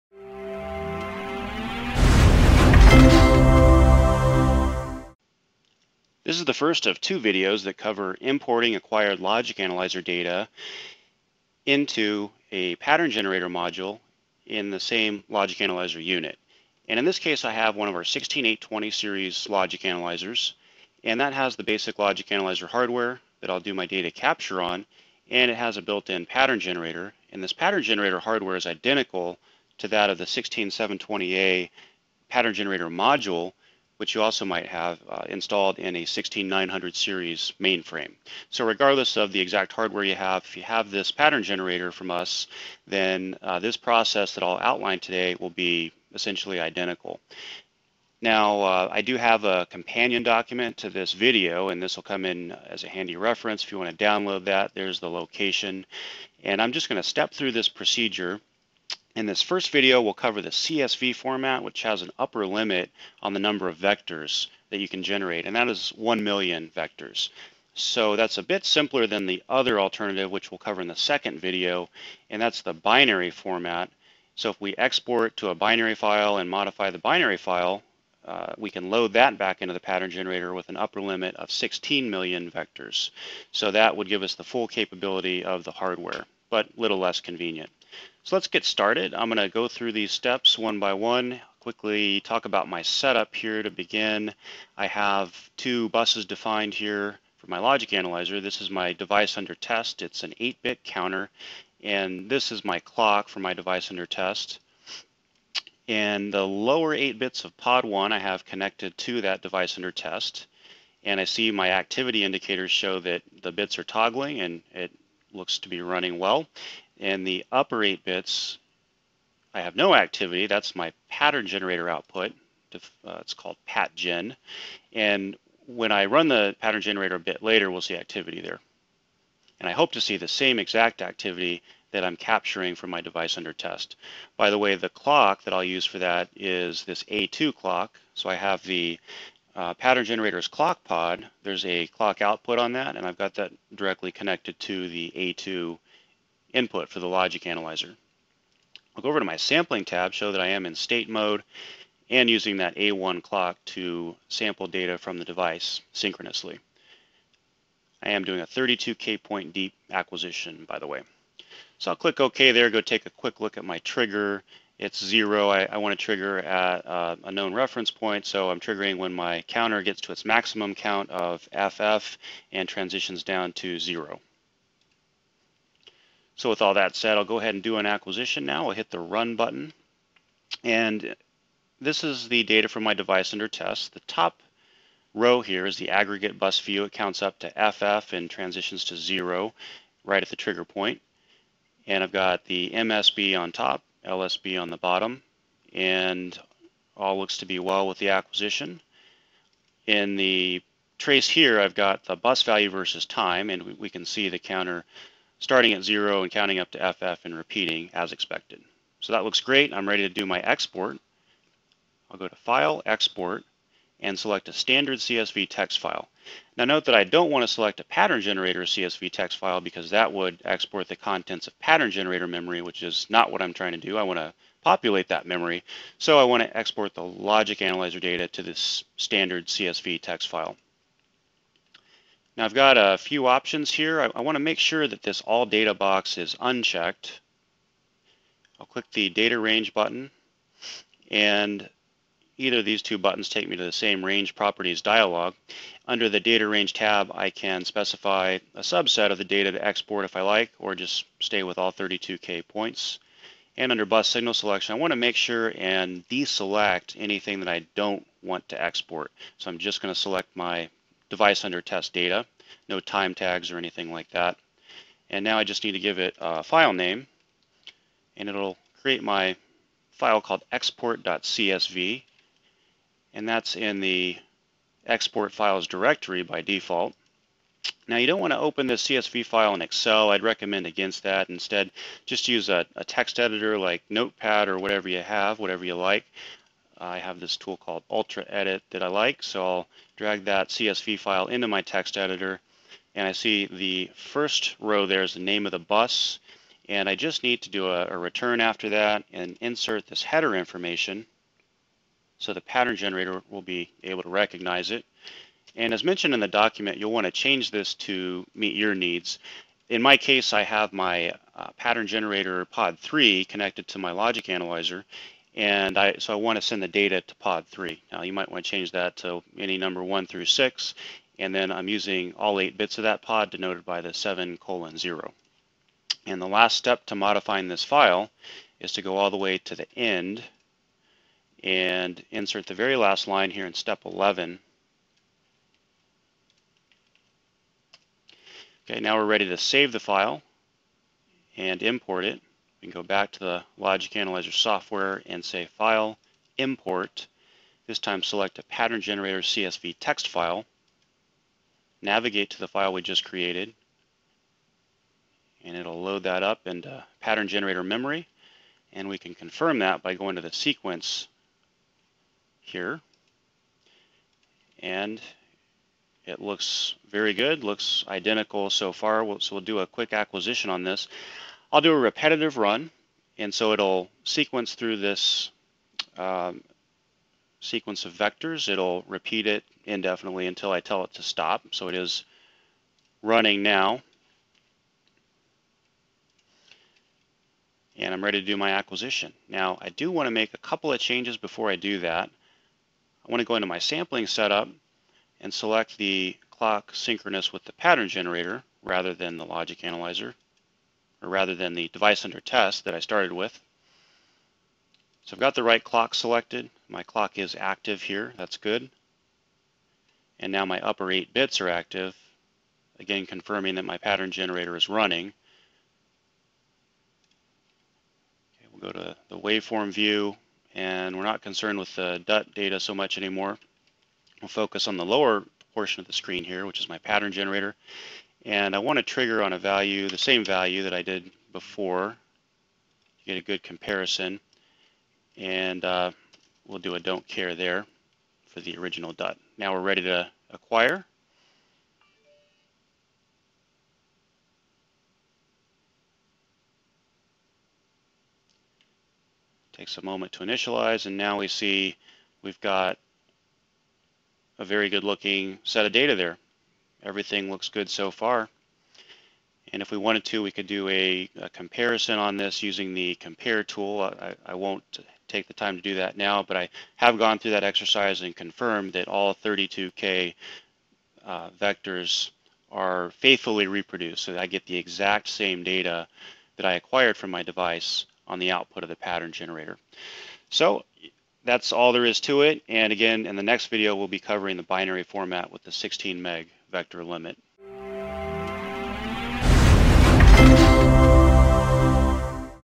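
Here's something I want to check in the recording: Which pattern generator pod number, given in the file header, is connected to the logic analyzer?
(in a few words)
3.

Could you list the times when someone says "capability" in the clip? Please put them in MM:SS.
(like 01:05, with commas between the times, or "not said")
01:24.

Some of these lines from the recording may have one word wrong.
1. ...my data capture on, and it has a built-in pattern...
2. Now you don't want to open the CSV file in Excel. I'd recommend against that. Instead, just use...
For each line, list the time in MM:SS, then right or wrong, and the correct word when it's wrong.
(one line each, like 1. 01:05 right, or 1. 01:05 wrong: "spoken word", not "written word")
1. 00:23 right
2. 04:37 right.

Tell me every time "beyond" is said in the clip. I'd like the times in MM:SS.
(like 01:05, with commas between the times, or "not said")
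not said.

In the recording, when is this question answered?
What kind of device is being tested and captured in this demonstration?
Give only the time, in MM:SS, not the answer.
01:40.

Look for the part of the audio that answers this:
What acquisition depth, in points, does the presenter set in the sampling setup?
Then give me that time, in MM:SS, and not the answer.
02:38.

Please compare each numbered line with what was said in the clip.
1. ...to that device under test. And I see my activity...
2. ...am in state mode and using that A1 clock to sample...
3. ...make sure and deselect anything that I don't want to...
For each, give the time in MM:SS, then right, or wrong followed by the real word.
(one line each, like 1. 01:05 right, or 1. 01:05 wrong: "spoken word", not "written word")
1. 01:48 right
2. 02:30 right
3. 04:14 right.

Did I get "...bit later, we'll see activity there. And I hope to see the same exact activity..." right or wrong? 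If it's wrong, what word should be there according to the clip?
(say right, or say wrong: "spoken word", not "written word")
right.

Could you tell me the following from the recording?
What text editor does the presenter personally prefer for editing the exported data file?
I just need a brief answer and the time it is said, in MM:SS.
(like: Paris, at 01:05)
Ultra Edit, at 04:47.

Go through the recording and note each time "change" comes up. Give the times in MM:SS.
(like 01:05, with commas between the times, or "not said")
05:07, 05:18, 06:30.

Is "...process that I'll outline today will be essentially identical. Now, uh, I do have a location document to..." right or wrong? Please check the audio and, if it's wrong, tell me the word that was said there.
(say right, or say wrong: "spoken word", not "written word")
wrong: "companion", not "location".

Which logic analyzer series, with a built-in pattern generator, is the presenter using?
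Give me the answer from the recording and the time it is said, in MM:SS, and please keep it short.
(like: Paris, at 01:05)
16820, at 00:18.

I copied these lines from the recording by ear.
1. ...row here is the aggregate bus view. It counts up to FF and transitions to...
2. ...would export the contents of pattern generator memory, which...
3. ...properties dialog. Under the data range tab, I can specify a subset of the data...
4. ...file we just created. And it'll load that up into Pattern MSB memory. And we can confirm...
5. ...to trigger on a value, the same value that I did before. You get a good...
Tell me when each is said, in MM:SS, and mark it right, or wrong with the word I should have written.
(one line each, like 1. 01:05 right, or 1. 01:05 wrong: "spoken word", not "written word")
1. 03:05 right
2. 03:40 right
3. 04:04 right
4. 05:52 wrong: "Generator", not "MSB"
5. 07:08 right.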